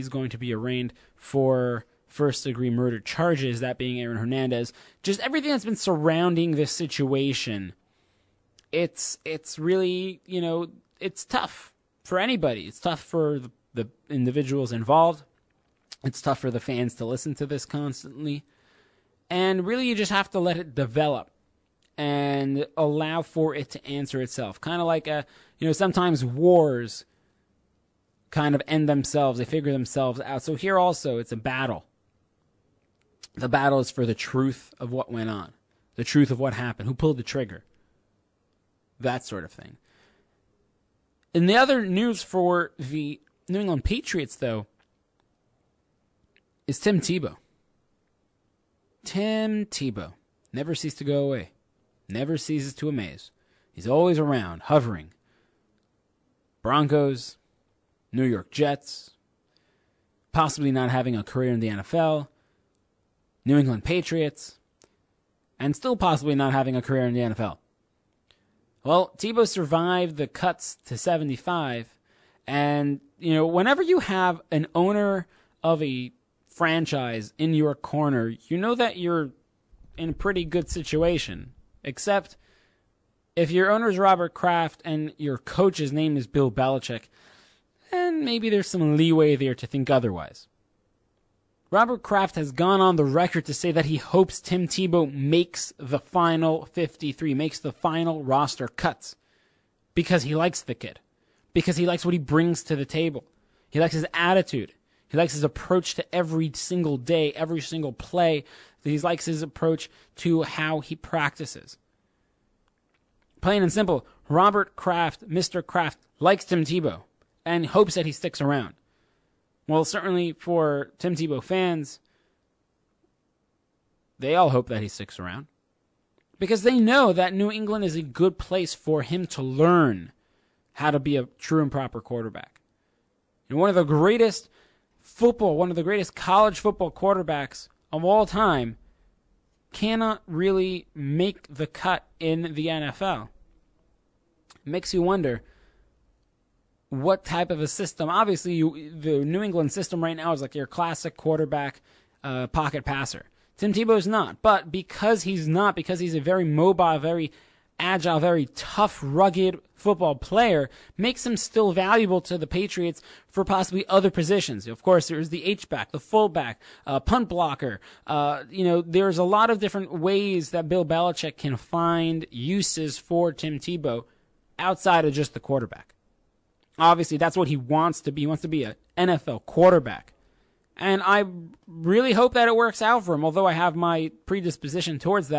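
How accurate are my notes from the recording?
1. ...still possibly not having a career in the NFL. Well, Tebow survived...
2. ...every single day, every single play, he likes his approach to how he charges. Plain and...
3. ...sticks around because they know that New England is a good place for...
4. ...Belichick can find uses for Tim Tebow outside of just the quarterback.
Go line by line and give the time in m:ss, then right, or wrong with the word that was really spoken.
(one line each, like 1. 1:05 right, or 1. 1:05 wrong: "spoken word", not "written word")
1. 1:05 right
2. 1:46 wrong: "practices", not "charges"
3. 2:04 right
4. 2:50 right.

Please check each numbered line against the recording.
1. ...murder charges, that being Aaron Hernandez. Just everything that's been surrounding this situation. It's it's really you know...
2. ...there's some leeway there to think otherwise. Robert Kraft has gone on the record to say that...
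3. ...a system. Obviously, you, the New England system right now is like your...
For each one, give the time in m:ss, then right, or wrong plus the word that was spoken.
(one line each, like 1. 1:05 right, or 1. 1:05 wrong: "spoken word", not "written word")
1. 0:02 right
2. 1:28 right
3. 2:27 right.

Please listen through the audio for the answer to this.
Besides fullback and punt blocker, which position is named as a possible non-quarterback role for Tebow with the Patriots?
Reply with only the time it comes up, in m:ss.
2:45.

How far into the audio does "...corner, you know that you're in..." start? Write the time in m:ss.
1:17.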